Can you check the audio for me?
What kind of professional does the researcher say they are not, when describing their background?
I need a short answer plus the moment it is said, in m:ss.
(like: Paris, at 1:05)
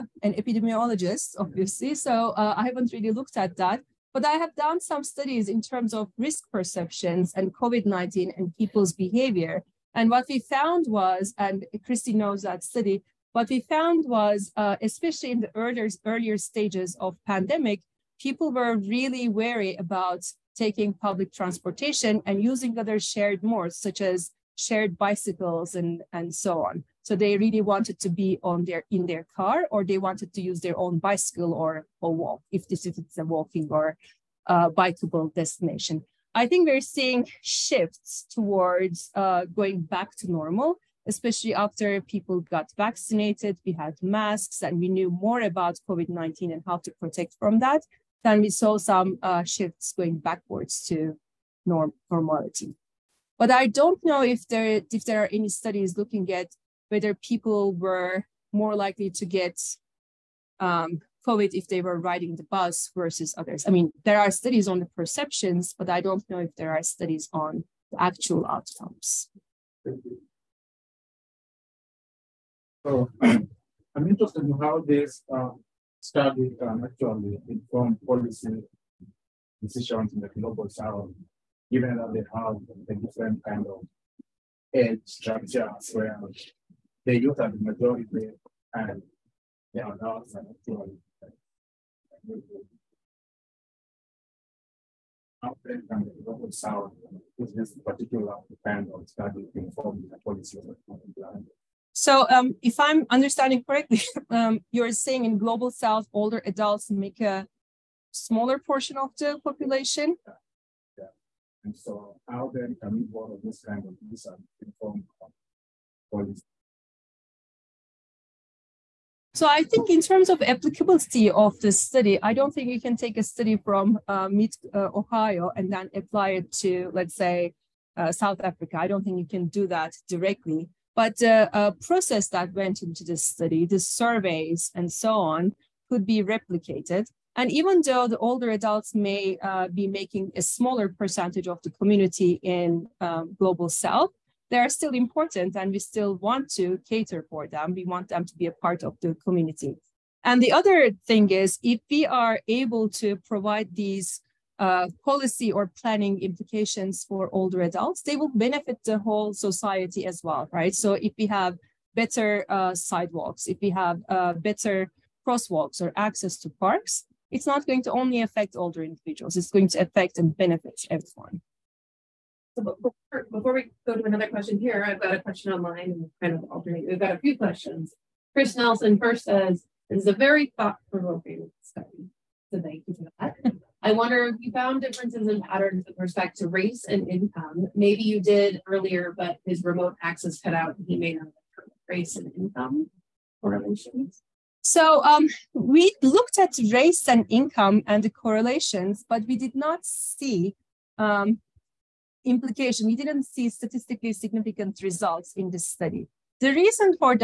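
epidemiologist, at 0:00.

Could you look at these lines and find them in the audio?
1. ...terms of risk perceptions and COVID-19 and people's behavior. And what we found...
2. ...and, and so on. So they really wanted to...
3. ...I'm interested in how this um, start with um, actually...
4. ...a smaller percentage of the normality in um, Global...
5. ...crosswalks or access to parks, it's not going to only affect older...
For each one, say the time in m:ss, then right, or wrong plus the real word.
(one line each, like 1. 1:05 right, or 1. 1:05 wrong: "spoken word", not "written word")
1. 0:05 right
2. 0:25 right
3. 1:13 right
4. 2:20 wrong: "community", not "normality"
5. 2:45 right.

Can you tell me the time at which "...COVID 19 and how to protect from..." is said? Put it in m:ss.
0:45.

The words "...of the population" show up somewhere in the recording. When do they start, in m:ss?
1:48.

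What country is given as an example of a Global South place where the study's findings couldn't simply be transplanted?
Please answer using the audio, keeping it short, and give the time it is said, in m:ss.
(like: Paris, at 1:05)
South Africa, at 2:08.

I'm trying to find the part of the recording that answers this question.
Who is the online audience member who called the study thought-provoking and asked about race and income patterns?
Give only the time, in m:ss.
2:58.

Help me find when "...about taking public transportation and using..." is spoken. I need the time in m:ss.
0:19.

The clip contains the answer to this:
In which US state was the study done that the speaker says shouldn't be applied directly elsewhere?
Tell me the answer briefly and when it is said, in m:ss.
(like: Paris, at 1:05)
Ohio, at 2:04.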